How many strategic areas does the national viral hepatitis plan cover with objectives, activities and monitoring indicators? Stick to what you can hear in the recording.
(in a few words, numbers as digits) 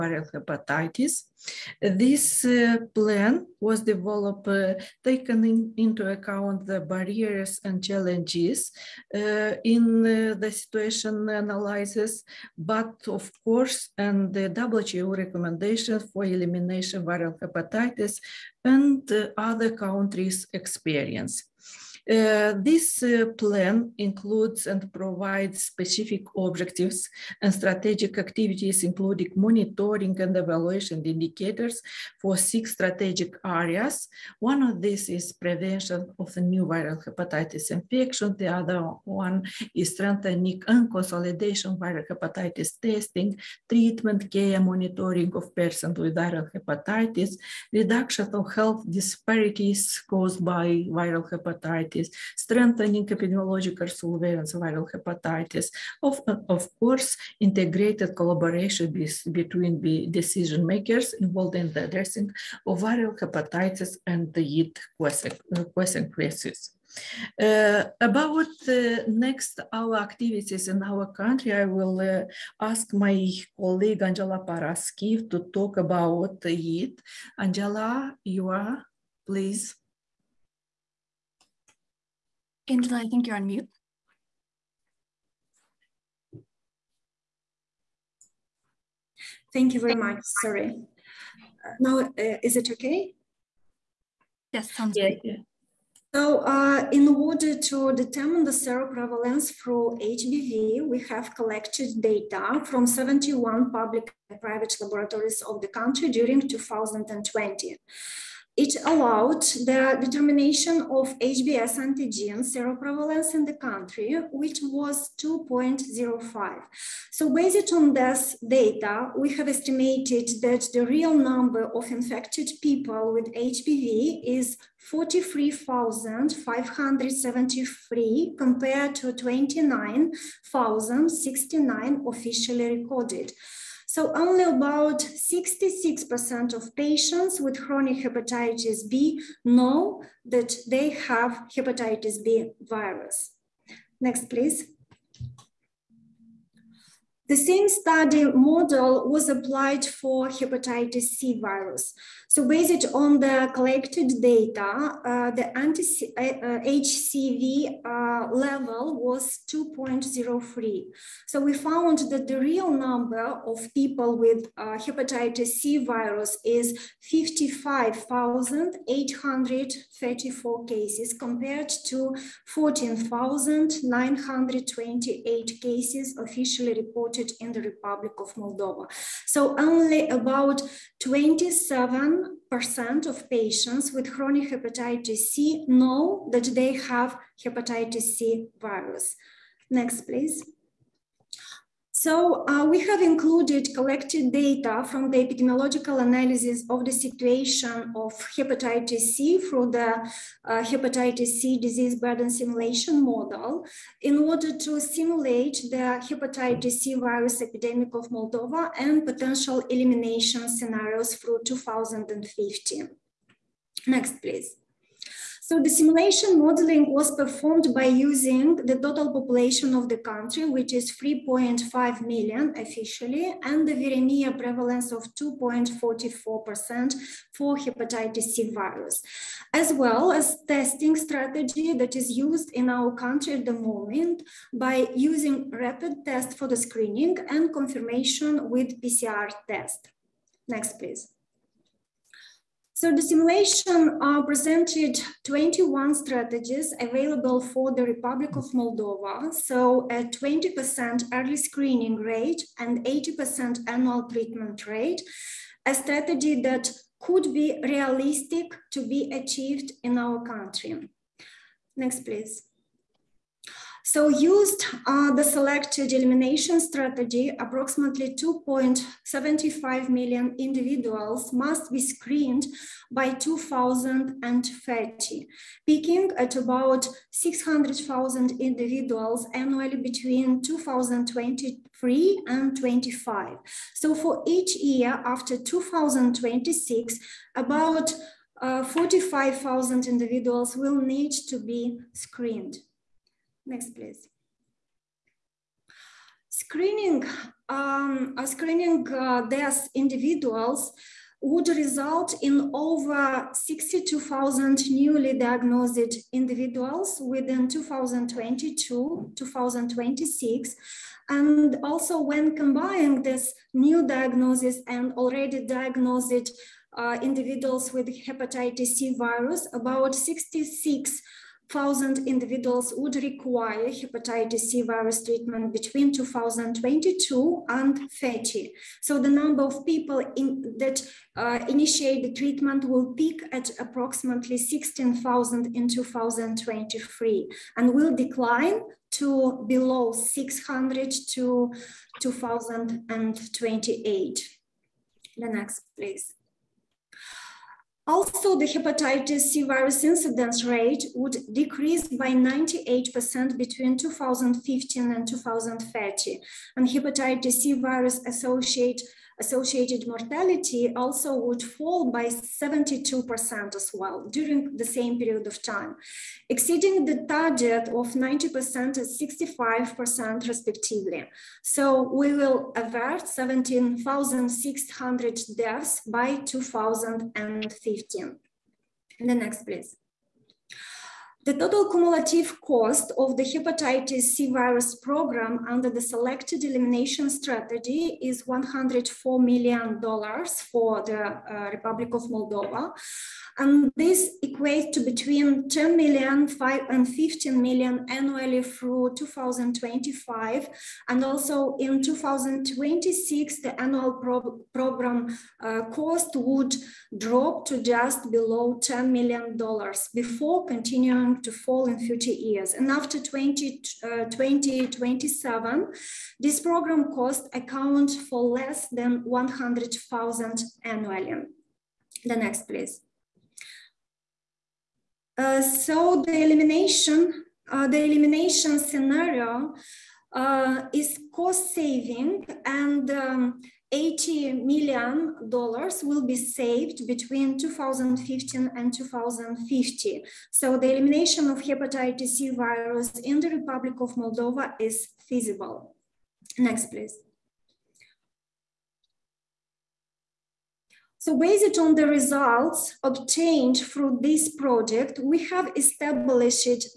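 6.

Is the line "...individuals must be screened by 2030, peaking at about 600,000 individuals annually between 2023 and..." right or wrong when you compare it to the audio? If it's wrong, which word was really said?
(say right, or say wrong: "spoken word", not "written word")
right.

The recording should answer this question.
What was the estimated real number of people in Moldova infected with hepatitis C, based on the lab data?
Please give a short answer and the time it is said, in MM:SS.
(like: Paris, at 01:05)
55,834, at 02:47.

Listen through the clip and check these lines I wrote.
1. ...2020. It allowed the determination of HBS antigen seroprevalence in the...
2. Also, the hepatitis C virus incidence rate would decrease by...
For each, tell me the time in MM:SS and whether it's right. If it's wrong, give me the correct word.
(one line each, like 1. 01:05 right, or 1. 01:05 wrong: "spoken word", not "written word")
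1. 01:46 right
2. 05:47 right.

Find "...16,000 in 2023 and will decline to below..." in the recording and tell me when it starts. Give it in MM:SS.
05:34.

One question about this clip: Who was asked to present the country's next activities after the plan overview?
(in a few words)
Angela Paraschiv.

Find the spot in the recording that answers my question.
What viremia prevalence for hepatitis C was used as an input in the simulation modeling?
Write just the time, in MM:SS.
03:45.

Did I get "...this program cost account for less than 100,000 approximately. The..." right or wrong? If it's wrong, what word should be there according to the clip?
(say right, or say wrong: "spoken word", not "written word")
wrong: "annually", not "approximately".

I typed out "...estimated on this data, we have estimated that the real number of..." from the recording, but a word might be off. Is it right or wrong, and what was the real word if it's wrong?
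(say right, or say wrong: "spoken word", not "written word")
wrong: "based", not "estimated".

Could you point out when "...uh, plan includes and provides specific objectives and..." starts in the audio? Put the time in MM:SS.
00:23.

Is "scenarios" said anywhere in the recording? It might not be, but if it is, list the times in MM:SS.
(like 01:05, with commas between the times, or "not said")
03:30, 07:08.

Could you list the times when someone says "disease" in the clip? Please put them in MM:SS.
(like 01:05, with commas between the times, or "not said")
03:21.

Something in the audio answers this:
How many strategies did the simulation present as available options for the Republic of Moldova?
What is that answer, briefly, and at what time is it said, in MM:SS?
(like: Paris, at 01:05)
21, at 04:05.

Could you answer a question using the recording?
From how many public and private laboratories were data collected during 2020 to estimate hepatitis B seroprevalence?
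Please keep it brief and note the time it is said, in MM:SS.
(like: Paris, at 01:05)
71, at 01:42.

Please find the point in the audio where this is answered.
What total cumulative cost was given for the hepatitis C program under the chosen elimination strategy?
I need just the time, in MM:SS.
06:28.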